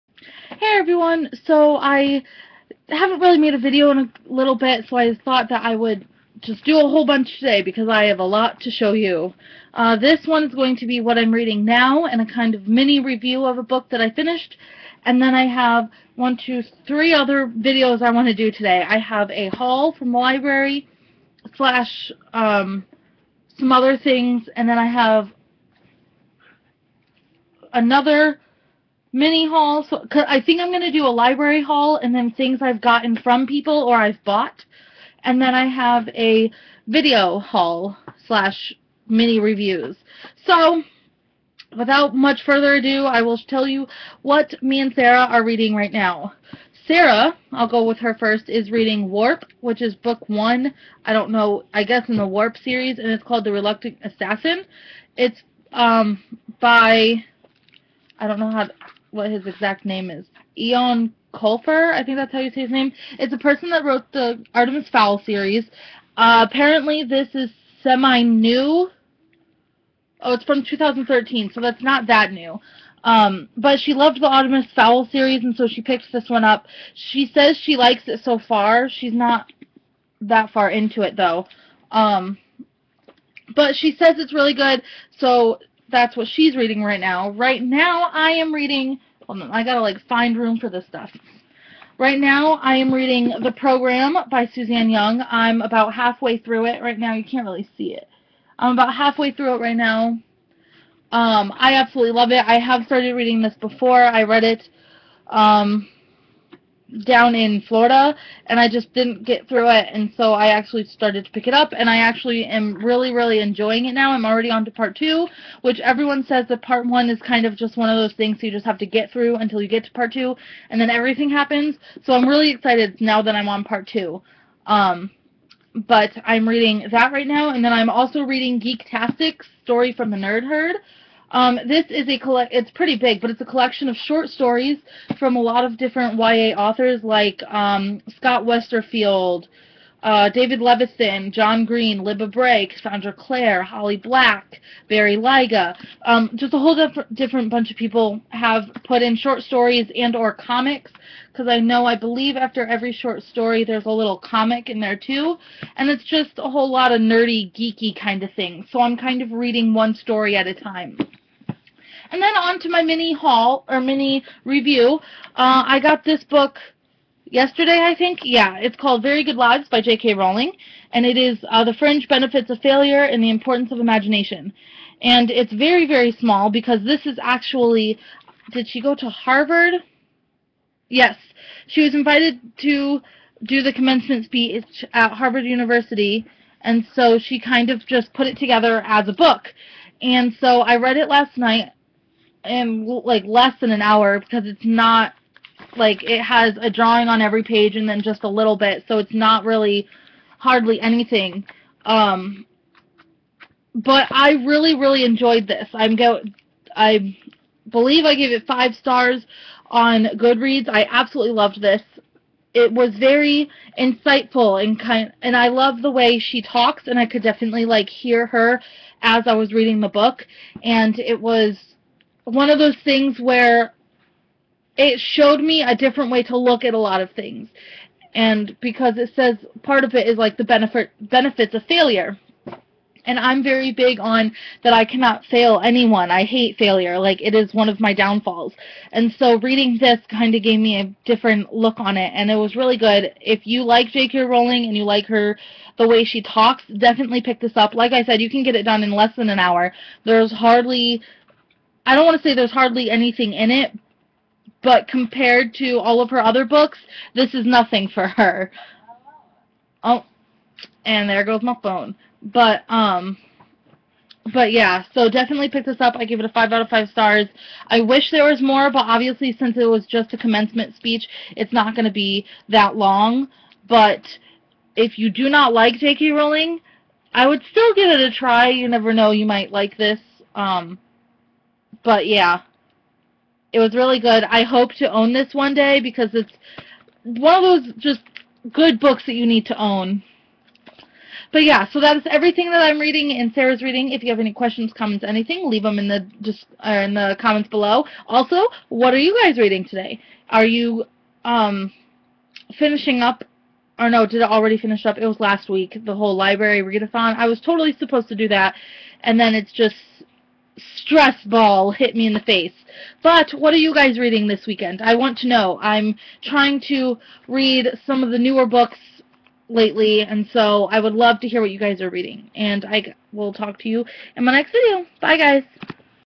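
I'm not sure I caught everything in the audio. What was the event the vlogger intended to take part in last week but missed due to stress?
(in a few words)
library readathon.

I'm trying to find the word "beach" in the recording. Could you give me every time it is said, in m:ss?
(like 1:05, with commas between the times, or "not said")
not said.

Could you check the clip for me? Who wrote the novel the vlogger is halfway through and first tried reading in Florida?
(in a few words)
Suzanne Young.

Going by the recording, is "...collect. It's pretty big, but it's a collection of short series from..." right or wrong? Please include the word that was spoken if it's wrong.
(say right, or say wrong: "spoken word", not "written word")
wrong: "stories", not "series".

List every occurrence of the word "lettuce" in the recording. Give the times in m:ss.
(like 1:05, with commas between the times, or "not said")
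not said.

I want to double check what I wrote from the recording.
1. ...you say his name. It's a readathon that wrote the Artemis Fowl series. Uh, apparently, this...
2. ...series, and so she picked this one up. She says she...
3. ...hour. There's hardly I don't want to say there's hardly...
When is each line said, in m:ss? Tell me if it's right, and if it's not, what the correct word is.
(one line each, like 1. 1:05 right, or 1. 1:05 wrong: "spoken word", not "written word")
1. 1:02 wrong: "person", not "readathon"
2. 1:15 right
3. 4:09 right.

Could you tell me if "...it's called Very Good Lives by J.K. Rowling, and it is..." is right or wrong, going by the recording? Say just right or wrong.
right.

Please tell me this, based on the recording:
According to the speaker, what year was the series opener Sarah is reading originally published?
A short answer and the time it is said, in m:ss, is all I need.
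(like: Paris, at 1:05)
2013, at 1:10.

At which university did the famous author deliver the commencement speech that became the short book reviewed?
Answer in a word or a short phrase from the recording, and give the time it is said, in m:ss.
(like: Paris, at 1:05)
Harvard University, at 3:05.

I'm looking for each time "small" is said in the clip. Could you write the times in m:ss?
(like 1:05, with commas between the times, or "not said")
2:56.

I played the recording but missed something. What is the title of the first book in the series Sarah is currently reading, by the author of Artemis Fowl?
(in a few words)
The Reluctant Assassin.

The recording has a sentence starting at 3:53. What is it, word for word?
And I'm very big on that I cannot fail anyone.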